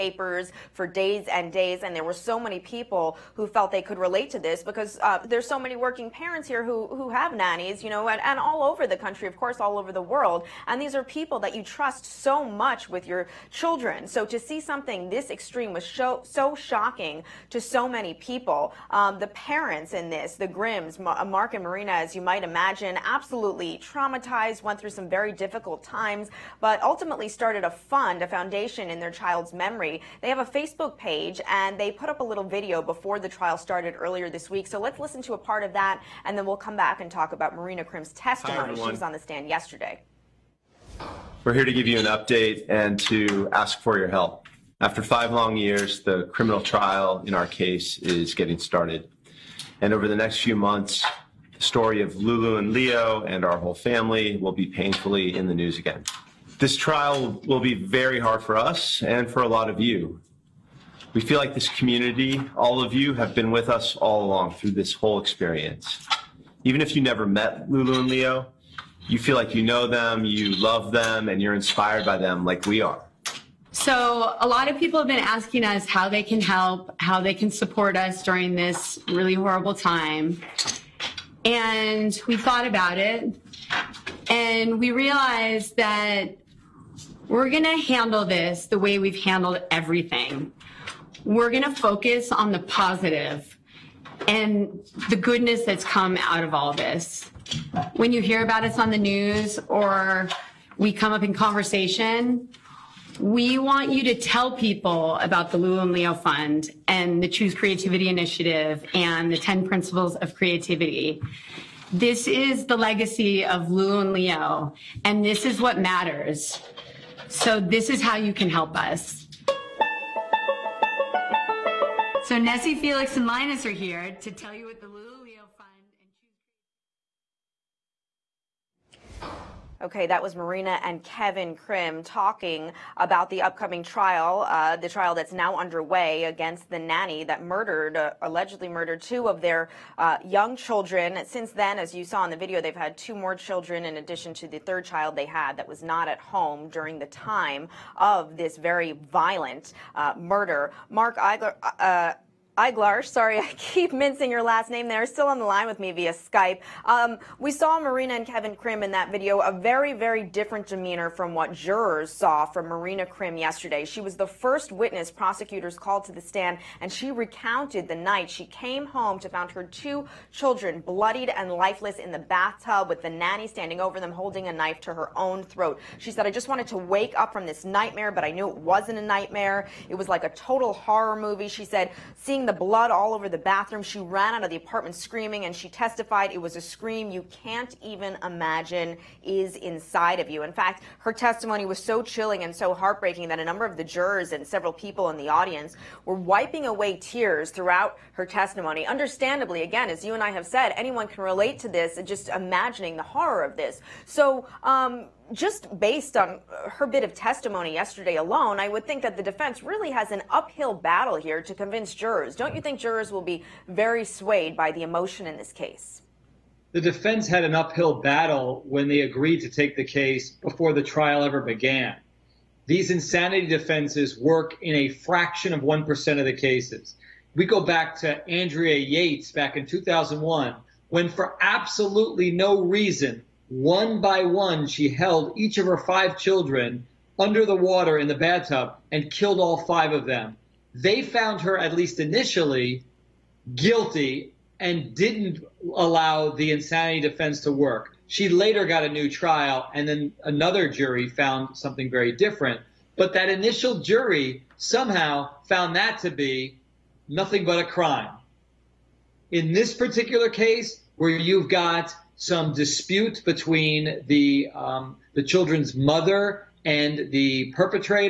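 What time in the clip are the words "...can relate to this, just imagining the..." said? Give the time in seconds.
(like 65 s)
201 s.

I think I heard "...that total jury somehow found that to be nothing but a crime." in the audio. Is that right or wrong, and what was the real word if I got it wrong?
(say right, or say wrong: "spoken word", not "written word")
wrong: "initial", not "total".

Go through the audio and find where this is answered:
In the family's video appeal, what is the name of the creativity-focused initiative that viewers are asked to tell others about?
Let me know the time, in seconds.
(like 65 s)
107 s.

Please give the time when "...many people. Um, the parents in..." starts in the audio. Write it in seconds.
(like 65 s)
17 s.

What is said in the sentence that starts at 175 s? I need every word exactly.
She said, I just wanted to wake up from this nightmare, but I knew it wasn't a nightmare.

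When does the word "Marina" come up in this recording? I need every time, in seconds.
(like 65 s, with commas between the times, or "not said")
21 s, 37 s, 130 s, 157 s, 162 s.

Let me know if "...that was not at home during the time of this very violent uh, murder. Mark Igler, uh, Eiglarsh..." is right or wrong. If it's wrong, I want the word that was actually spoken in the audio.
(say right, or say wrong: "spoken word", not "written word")
right.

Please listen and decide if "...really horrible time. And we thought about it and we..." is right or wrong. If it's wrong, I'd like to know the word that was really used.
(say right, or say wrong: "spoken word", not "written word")
right.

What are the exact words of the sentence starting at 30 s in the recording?
They have a Facebook page and they put up a little video before the trial started earlier this week.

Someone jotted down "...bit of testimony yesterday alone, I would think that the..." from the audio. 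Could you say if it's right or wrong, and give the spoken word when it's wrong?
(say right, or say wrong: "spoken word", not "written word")
right.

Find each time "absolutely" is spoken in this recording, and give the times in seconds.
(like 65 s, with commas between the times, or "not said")
23 s, 231 s.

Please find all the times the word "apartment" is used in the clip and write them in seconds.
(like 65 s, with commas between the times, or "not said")
184 s.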